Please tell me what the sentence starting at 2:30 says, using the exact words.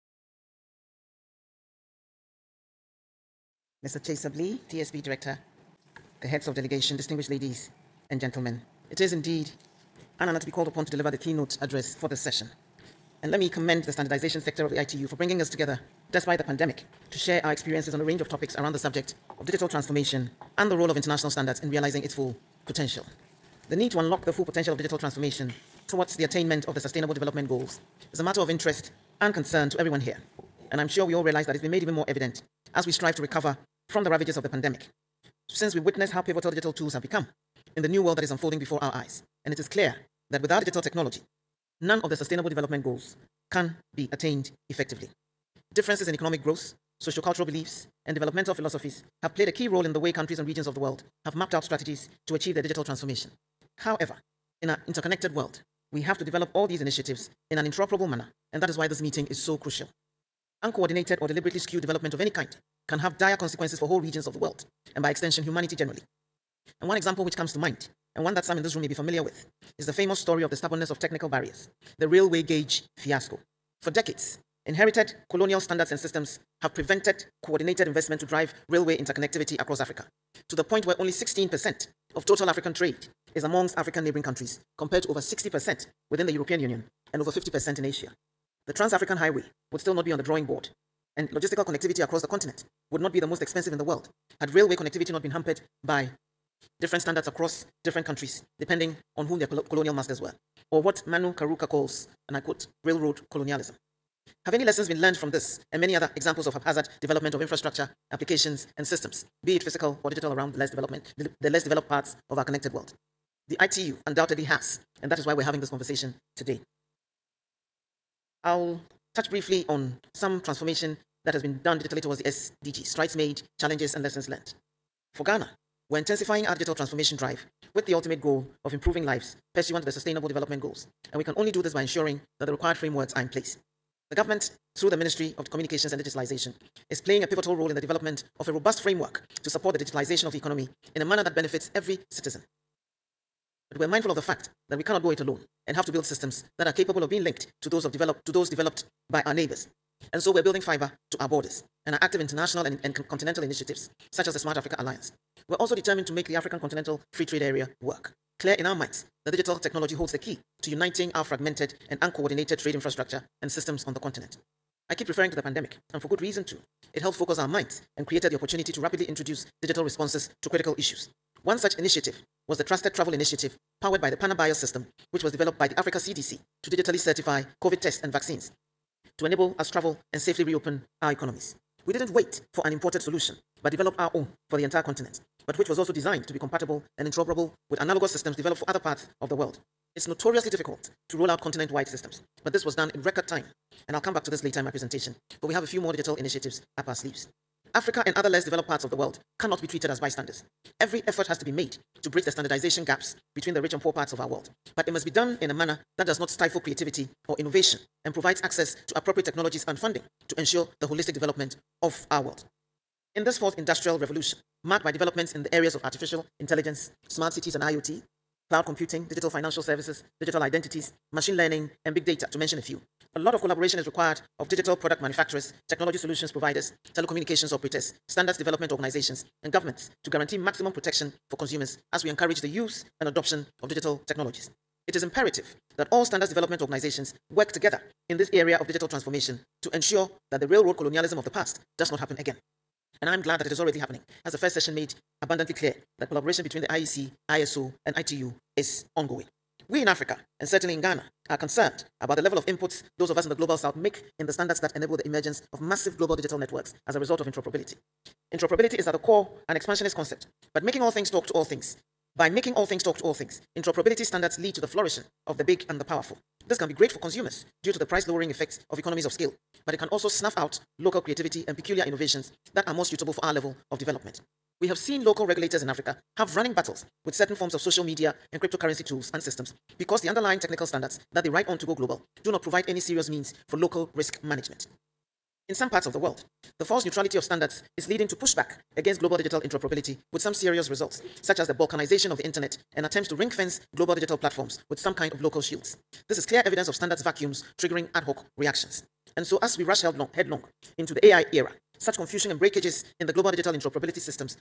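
And so we're building fiber to our borders and are active international and, and continental initiatives such as the Smart Africa Alliance.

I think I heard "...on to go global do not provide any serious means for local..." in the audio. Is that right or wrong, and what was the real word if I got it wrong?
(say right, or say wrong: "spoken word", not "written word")
right.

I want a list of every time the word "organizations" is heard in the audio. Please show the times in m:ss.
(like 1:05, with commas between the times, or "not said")
3:48, 3:56.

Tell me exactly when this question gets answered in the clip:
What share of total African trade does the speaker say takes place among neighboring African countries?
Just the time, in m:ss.
1:21.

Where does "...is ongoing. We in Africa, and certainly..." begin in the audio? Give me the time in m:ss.
4:08.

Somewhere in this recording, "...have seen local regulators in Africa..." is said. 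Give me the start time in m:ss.
4:34.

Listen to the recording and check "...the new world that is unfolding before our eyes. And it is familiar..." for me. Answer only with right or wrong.
wrong.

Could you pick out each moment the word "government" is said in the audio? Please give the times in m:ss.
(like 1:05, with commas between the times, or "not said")
2:14, 3:49.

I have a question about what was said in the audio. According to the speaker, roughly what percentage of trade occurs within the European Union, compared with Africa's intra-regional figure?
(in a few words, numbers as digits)
Over 60%.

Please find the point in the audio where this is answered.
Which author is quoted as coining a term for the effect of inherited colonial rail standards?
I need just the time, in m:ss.
1:41.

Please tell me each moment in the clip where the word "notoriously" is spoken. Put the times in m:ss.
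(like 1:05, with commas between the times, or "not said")
3:10.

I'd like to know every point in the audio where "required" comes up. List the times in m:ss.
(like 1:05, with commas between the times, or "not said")
2:12, 3:43.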